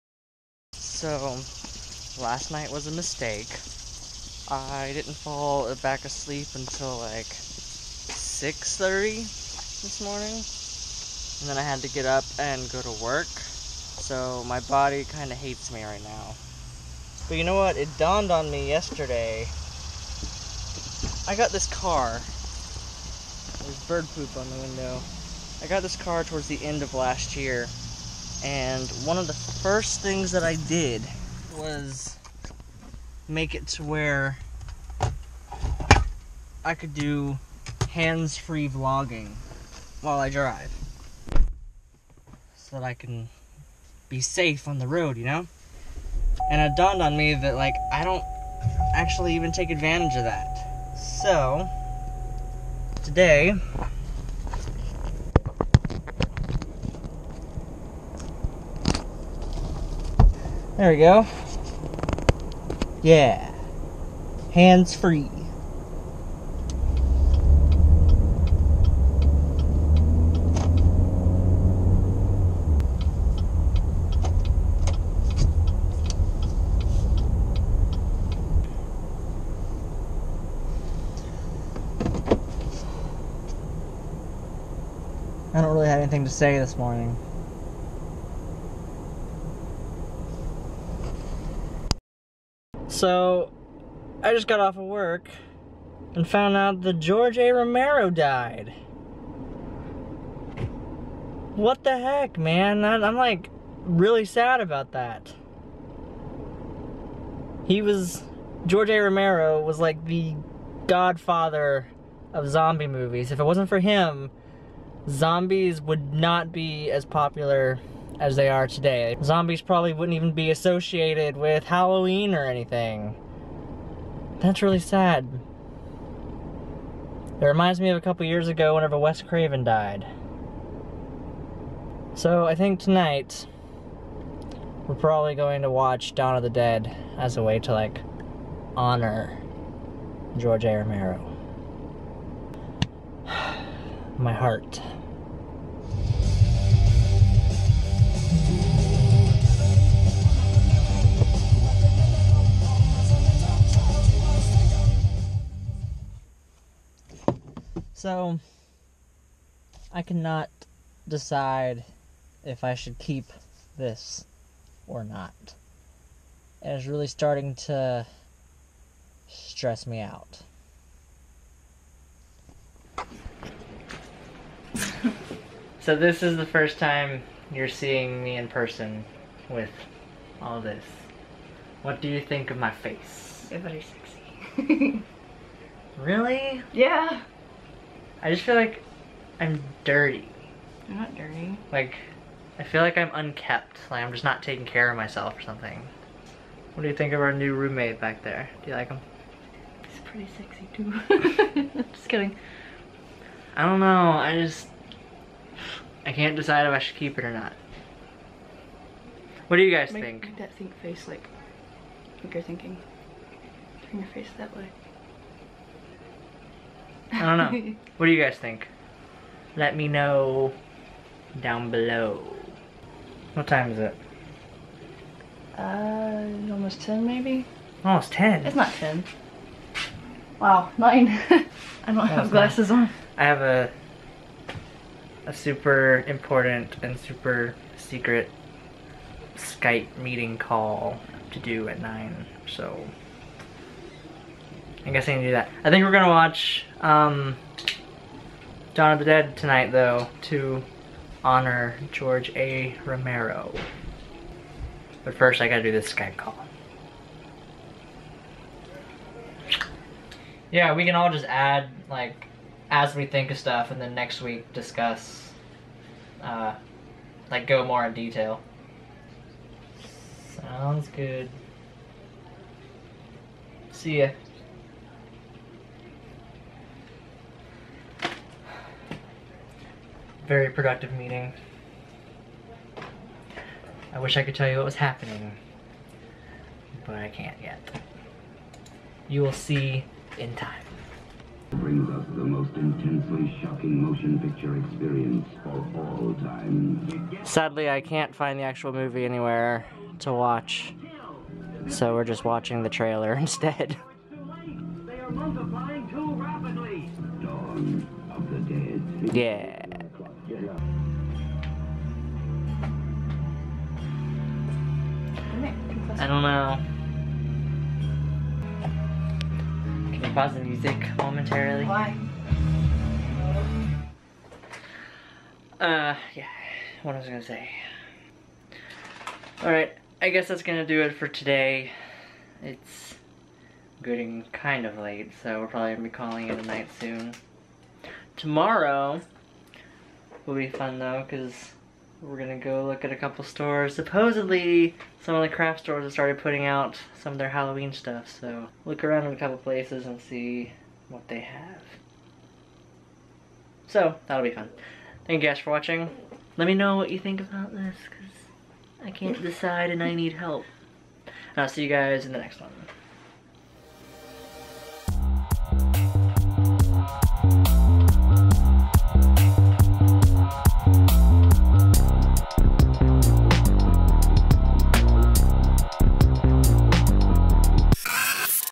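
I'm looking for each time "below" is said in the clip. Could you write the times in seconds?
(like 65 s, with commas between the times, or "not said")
221 s.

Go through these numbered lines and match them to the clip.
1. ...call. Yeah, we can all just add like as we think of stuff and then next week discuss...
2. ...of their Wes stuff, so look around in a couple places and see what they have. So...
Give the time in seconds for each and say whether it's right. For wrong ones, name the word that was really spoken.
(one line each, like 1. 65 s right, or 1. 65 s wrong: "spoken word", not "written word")
1. 256 s right
2. 347 s wrong: "Halloween", not "Wes".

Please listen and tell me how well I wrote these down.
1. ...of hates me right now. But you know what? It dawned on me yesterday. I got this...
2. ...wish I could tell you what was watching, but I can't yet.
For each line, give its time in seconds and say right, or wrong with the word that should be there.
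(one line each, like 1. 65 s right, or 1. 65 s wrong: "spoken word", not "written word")
1. 15 s right
2. 283 s wrong: "happening", not "watching".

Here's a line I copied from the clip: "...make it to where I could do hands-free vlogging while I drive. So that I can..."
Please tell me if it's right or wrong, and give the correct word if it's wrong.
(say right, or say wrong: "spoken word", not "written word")
right.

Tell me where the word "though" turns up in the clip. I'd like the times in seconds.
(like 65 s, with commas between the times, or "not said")
249 s, 340 s.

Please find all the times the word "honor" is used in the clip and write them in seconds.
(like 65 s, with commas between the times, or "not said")
138 s, 251 s.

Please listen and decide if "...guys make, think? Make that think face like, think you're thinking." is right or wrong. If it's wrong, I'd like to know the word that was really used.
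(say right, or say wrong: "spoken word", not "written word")
right.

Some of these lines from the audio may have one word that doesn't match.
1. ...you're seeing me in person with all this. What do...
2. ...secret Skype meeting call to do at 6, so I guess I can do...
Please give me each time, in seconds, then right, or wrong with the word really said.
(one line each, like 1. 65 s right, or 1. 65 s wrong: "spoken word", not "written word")
1. 177 s right
2. 237 s wrong: "9", not "6".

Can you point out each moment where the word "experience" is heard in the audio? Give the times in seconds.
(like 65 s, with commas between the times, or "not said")
294 s.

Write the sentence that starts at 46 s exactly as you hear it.
And it dawned on me that, like, I don't actually even take advantage of that.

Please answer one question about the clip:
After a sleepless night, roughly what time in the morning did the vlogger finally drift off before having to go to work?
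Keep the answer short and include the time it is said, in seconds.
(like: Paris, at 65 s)
6:30, at 7 s.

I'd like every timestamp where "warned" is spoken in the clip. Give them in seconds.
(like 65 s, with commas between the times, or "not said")
not said.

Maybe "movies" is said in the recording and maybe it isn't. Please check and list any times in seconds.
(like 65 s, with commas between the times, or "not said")
112 s, 298 s.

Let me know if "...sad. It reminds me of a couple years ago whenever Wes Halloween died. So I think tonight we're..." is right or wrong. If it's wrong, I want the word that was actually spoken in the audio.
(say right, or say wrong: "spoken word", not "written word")
wrong: "Craven", not "Halloween".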